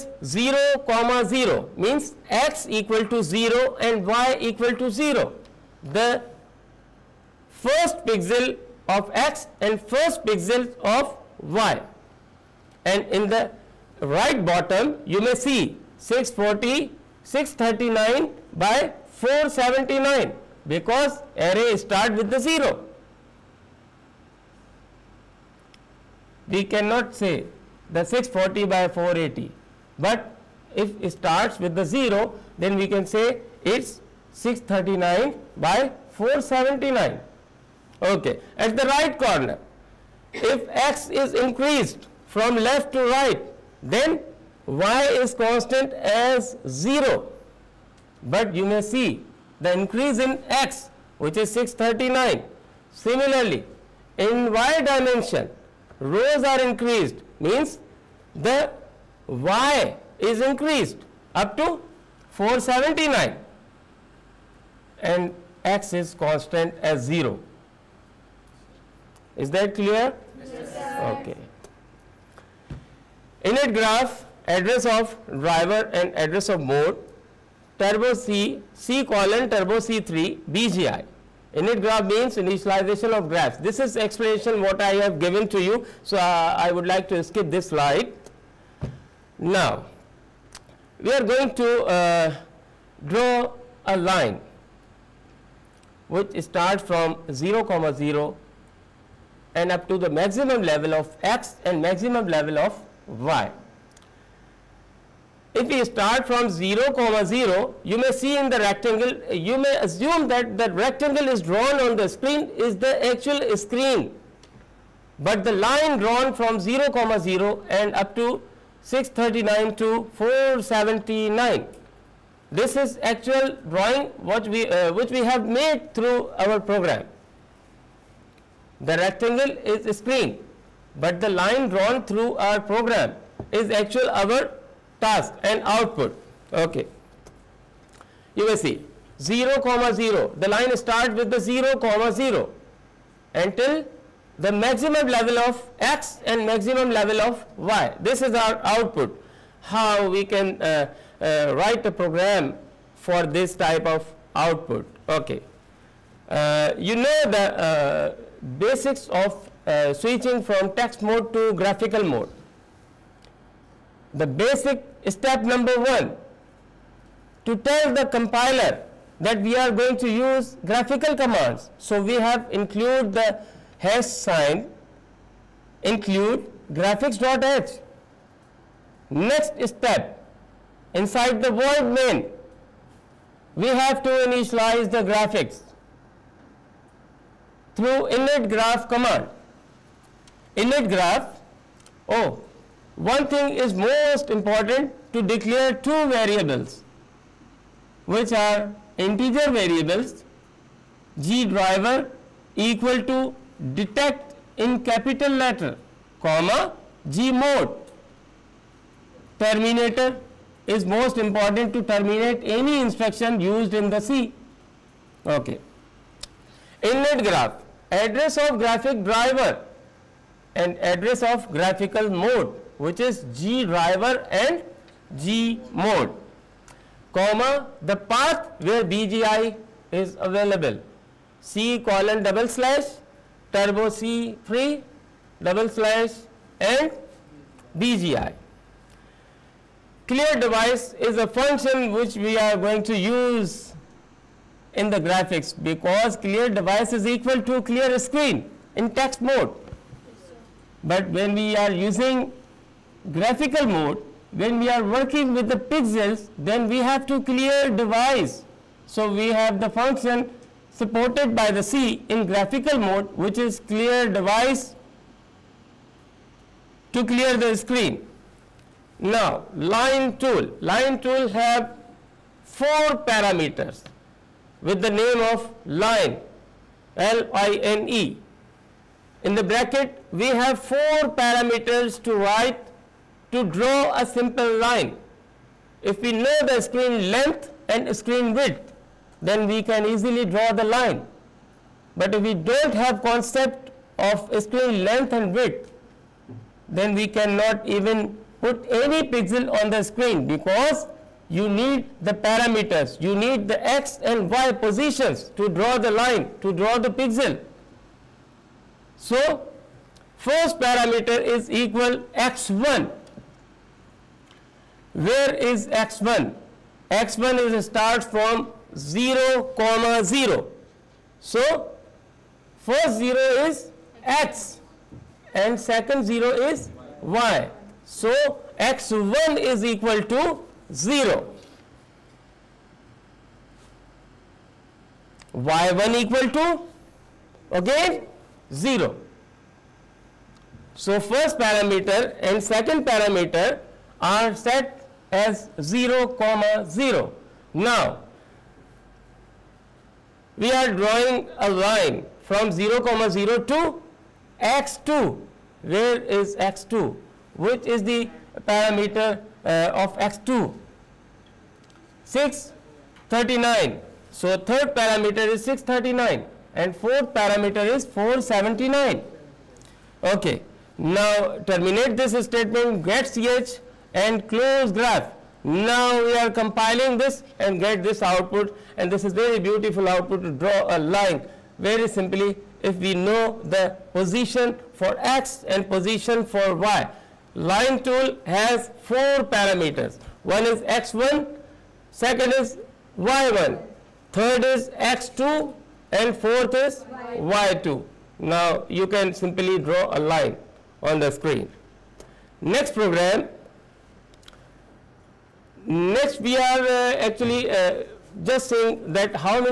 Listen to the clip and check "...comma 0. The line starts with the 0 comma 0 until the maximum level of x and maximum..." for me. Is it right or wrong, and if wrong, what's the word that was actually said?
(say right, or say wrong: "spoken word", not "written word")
right.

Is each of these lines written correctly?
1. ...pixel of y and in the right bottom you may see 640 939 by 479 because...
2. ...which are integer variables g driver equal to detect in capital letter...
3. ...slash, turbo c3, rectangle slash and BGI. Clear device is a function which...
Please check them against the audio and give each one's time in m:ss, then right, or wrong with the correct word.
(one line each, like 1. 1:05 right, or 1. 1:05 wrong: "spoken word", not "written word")
1. 0:10 wrong: "639", not "939"
2. 3:18 right
3. 3:52 wrong: "double", not "rectangle".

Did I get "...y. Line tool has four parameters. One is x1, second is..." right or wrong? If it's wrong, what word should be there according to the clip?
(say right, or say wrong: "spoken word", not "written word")
right.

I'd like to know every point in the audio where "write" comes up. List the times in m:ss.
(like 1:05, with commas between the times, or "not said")
2:31, 4:42.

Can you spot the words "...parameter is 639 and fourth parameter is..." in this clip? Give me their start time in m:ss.
6:04.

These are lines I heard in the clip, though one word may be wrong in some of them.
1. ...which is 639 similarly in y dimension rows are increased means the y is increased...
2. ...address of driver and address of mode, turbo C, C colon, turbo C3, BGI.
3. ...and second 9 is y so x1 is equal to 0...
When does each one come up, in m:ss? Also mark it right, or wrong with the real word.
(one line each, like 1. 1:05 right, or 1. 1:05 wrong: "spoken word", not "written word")
1. 0:51 right
2. 1:14 right
3. 5:25 wrong: "0", not "9".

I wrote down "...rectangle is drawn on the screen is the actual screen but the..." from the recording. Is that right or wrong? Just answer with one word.
right.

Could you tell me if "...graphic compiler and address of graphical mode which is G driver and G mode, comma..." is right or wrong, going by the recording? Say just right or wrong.
wrong.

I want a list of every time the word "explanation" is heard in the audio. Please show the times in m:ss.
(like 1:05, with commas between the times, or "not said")
1:23.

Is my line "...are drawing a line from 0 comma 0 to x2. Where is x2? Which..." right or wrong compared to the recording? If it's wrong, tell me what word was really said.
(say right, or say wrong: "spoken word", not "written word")
right.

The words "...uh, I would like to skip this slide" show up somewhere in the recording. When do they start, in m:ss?
1:26.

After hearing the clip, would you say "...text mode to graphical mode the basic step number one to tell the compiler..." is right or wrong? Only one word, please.
right.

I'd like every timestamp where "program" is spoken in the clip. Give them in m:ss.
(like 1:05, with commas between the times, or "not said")
2:06, 2:12, 2:31, 6:42.